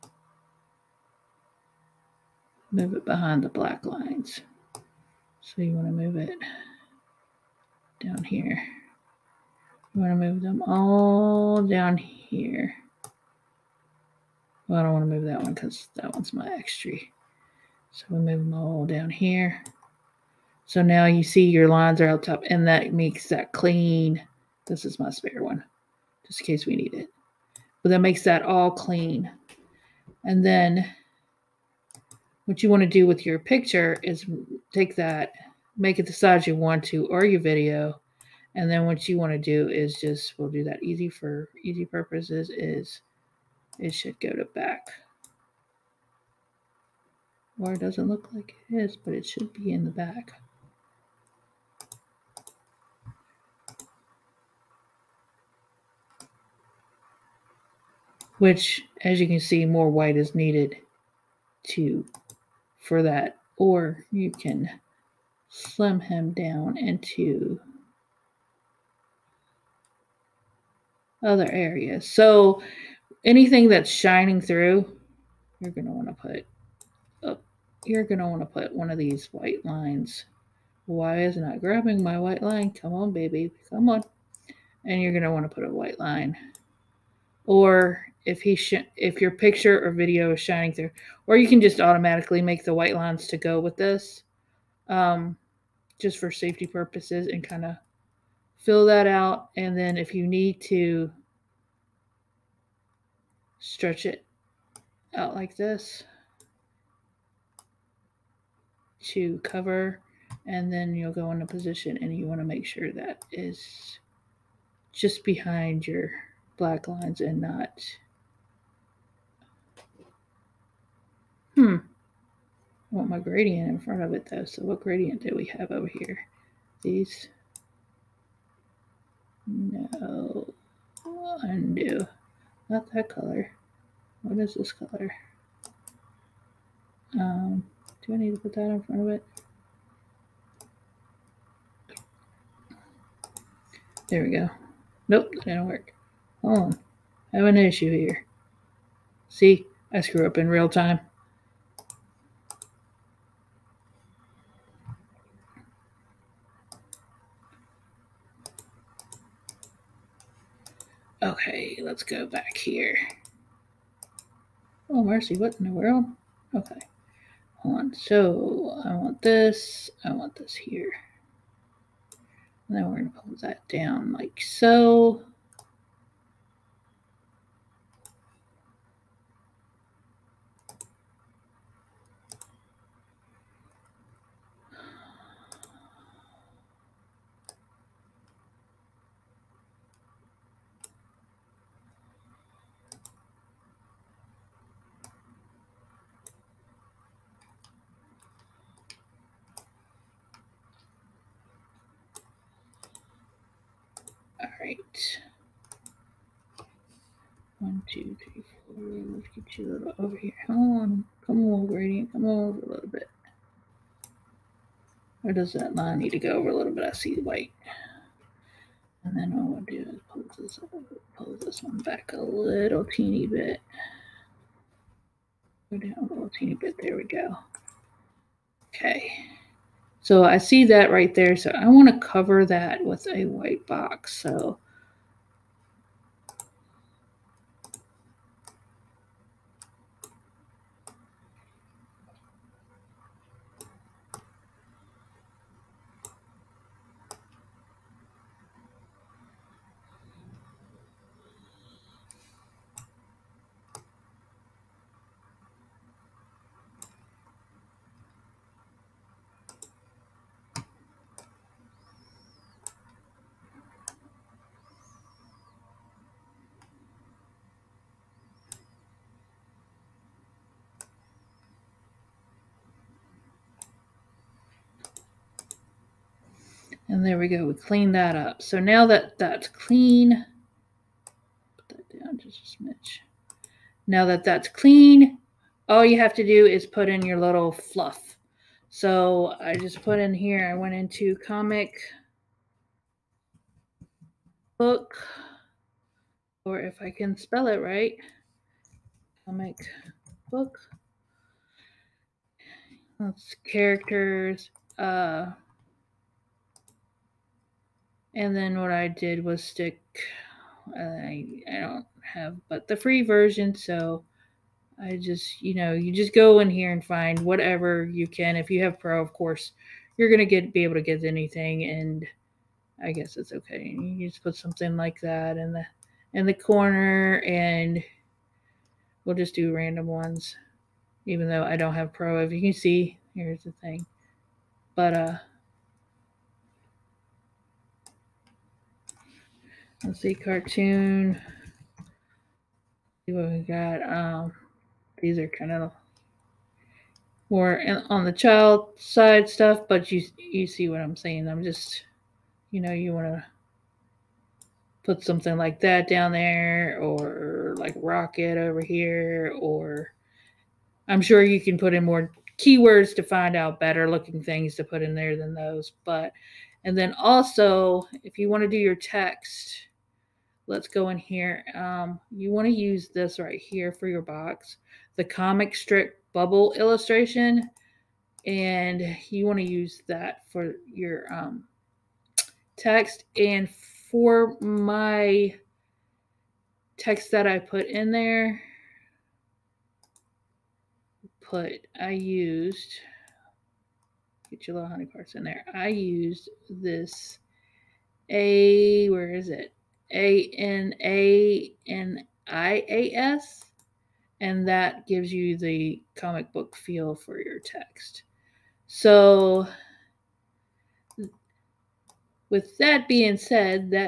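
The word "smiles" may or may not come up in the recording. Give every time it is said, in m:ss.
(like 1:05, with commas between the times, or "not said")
not said.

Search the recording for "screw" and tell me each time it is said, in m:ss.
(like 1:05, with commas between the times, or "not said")
2:30.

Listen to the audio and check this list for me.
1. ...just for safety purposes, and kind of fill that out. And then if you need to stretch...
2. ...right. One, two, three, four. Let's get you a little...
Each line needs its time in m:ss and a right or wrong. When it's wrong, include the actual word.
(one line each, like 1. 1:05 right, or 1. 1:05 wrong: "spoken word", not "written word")
1. 1:36 right
2. 3:24 right.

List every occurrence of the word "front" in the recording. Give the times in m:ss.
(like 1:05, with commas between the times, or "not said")
2:03, 2:18.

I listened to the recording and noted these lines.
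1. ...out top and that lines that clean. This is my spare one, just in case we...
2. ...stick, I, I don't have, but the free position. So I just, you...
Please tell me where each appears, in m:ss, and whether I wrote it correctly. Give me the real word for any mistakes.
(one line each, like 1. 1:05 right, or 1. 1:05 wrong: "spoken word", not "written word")
1. 0:22 wrong: "makes", not "lines"
2. 5:09 wrong: "version", not "position".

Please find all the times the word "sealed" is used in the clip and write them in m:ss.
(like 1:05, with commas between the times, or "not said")
not said.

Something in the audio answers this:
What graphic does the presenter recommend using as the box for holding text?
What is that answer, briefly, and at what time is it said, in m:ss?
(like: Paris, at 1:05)
comic strip bubble illustration, at 6:15.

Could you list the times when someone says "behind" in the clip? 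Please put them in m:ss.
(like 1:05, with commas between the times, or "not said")
0:03, 1:55.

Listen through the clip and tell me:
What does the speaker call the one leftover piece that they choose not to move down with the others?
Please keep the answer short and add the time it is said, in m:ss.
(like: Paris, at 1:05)
my extra, at 0:16.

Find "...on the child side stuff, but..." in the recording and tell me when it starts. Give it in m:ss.
5:47.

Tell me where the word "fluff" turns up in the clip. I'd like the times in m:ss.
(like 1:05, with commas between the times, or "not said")
4:47.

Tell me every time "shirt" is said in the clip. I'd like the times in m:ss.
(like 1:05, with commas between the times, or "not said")
not said.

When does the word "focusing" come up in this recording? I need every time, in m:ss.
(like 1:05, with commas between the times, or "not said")
not said.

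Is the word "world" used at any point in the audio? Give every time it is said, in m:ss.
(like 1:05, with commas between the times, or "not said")
2:45.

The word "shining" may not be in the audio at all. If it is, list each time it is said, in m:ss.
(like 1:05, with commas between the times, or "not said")
1:13, 1:30.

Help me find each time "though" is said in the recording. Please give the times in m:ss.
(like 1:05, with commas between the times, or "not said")
2:04, 5:31.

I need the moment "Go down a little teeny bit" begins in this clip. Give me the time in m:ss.
3:45.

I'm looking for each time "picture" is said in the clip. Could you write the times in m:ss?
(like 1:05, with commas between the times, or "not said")
0:33, 1:29.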